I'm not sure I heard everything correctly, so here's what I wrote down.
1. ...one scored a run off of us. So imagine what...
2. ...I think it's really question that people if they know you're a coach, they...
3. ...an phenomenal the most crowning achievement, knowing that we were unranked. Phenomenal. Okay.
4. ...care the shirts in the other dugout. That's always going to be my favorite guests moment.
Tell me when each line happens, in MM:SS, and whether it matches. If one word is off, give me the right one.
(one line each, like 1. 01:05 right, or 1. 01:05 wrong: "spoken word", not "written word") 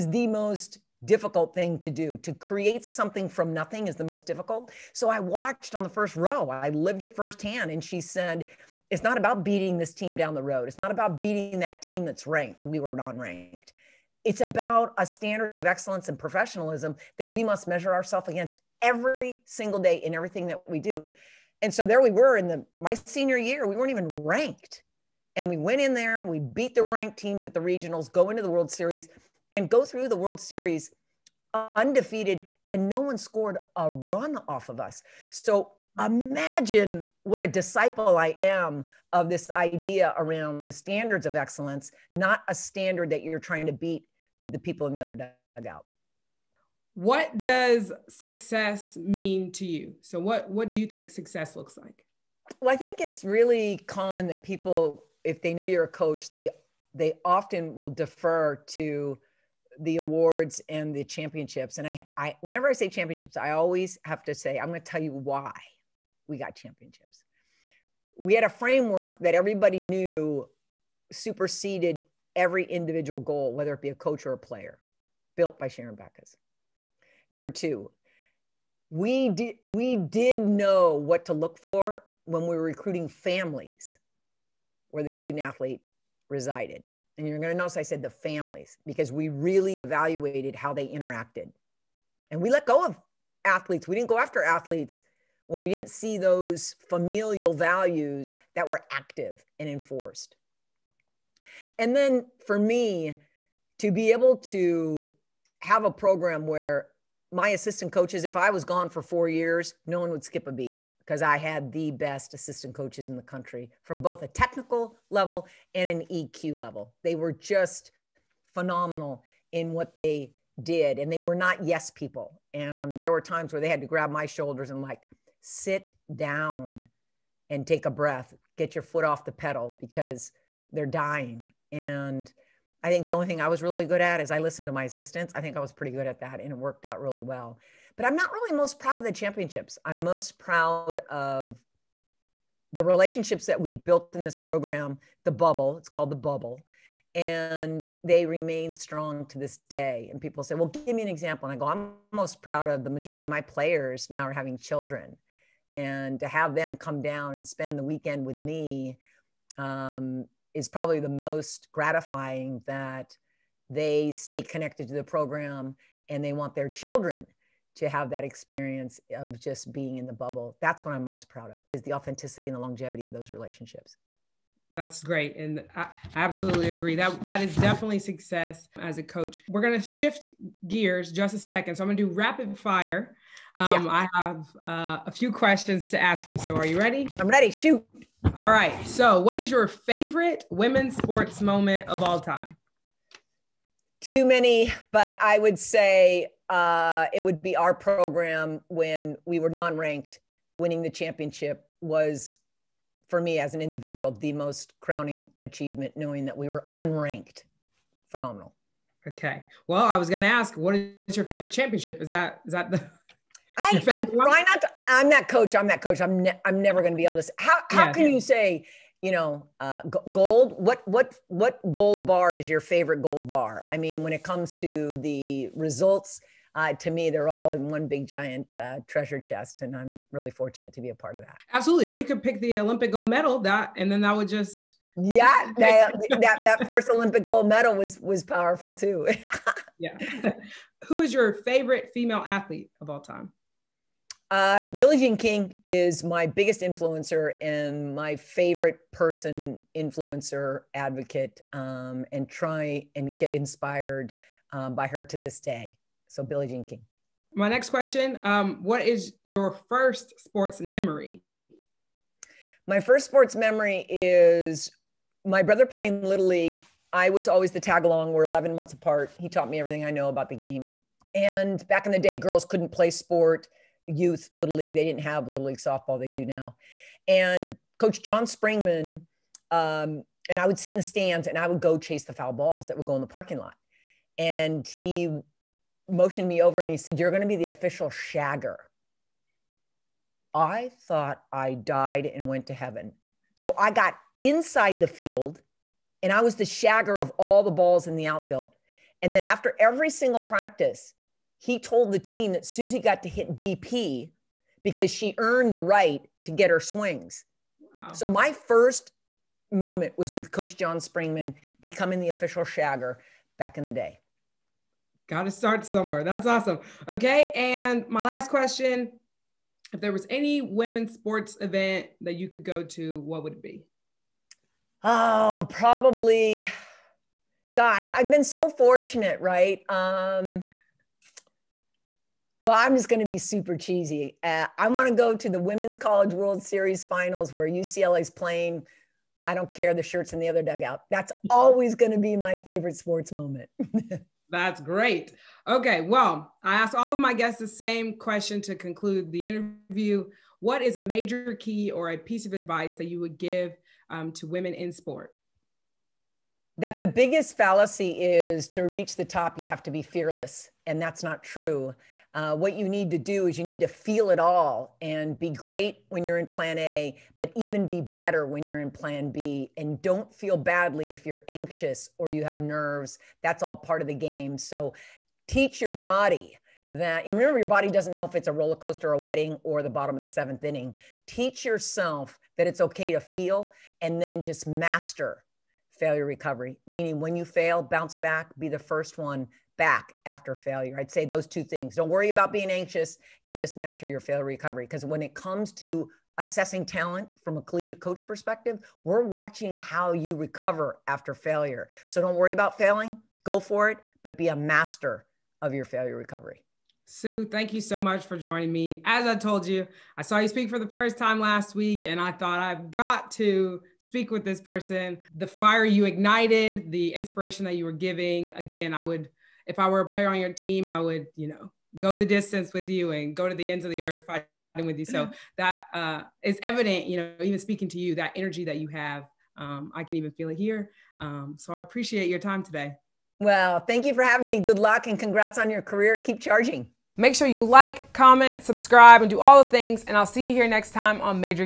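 1. 00:32 right
2. 00:52 wrong: "common", not "question"
3. 03:23 wrong: "individual", not "phenomenal"
4. 05:39 wrong: "sports", not "guests".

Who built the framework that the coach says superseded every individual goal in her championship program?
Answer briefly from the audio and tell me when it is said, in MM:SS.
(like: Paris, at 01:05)
Sharron Backus, at 01:15.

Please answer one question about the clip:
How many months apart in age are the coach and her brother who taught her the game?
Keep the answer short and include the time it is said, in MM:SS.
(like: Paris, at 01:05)
11, at 04:28.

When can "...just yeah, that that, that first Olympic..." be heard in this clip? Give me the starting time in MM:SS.
03:54.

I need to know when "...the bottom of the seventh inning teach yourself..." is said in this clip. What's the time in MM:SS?
06:19.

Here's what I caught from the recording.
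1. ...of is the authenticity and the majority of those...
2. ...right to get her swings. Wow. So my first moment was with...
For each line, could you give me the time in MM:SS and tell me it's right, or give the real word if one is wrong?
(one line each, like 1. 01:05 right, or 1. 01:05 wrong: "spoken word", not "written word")
1. 02:51 wrong: "longevity", not "majority"
2. 05:05 right.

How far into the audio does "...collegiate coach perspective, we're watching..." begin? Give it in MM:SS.
06:37.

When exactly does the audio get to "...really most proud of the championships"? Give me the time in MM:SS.
02:18.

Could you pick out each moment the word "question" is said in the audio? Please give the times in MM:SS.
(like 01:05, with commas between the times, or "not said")
03:05, 04:17, 05:18, 05:47.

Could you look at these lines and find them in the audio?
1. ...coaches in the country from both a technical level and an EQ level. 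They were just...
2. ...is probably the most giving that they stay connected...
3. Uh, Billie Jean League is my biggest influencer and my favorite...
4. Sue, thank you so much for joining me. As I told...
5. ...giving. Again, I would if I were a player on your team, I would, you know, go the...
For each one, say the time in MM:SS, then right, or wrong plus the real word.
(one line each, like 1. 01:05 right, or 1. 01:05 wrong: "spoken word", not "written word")
1. 01:52 right
2. 02:40 wrong: "gratifying", not "giving"
3. 04:04 wrong: "King", not "League"
4. 06:46 right
5. 06:57 right.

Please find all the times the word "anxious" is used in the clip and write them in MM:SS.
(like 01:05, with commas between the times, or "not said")
06:11, 06:32.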